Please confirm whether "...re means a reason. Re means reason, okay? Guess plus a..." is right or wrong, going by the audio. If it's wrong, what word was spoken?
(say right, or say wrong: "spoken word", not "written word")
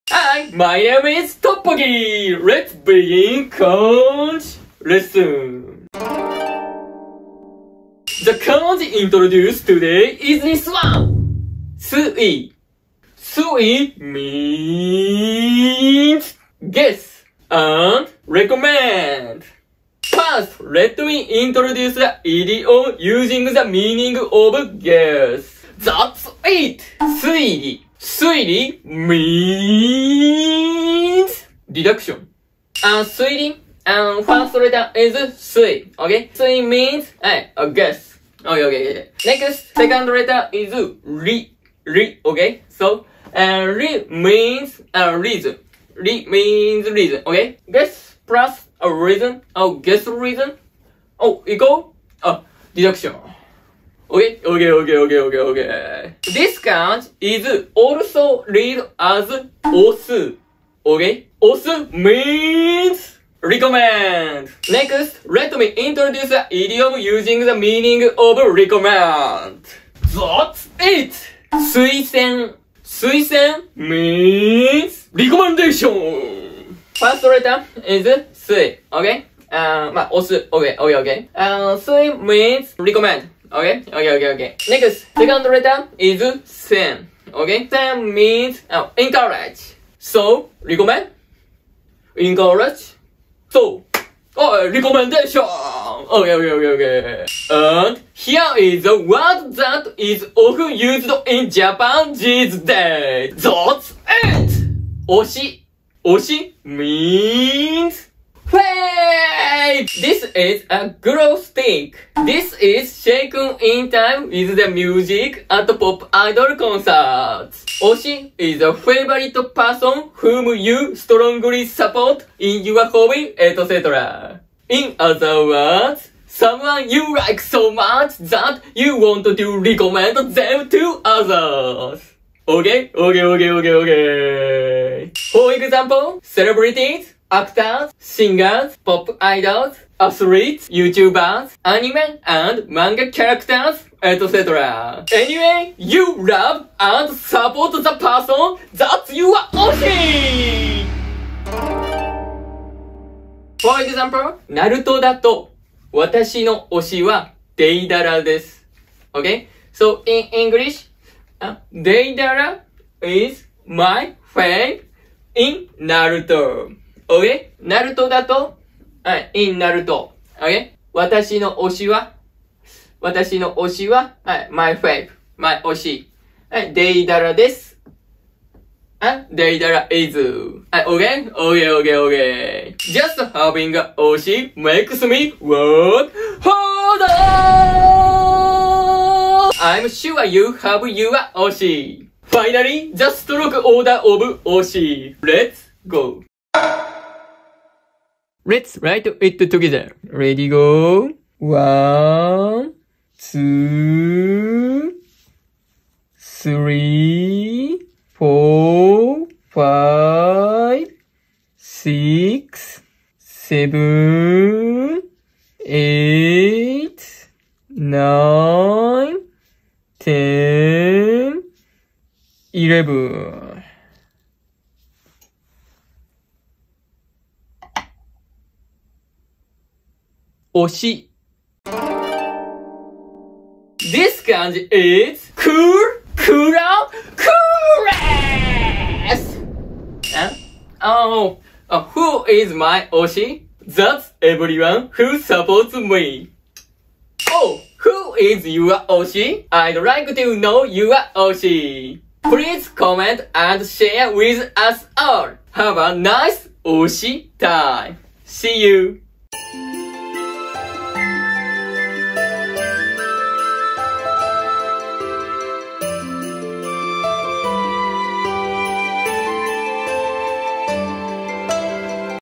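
right.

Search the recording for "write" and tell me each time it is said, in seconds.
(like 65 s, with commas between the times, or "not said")
198 s.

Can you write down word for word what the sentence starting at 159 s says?
So in English, h デ イ ダ ラ is my fave in Naruto.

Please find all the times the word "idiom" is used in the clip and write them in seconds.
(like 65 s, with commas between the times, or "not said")
22 s, 66 s.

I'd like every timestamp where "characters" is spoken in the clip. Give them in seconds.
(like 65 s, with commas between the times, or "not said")
143 s.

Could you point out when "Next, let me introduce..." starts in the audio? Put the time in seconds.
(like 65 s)
64 s.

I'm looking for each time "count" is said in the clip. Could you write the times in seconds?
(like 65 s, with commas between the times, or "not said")
3 s, 8 s, 56 s.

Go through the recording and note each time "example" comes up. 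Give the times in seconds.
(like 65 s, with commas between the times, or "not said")
135 s, 153 s.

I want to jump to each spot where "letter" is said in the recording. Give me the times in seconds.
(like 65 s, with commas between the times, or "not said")
34 s, 40 s, 77 s, 85 s.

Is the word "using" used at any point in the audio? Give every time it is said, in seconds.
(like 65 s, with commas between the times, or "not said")
22 s, 66 s.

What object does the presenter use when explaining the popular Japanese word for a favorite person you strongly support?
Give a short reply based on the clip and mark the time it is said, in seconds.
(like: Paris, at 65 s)
glow stick, at 110 s.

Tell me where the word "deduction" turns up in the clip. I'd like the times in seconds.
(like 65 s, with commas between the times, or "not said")
31 s, 52 s.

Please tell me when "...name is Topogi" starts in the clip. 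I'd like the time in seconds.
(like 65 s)
0 s.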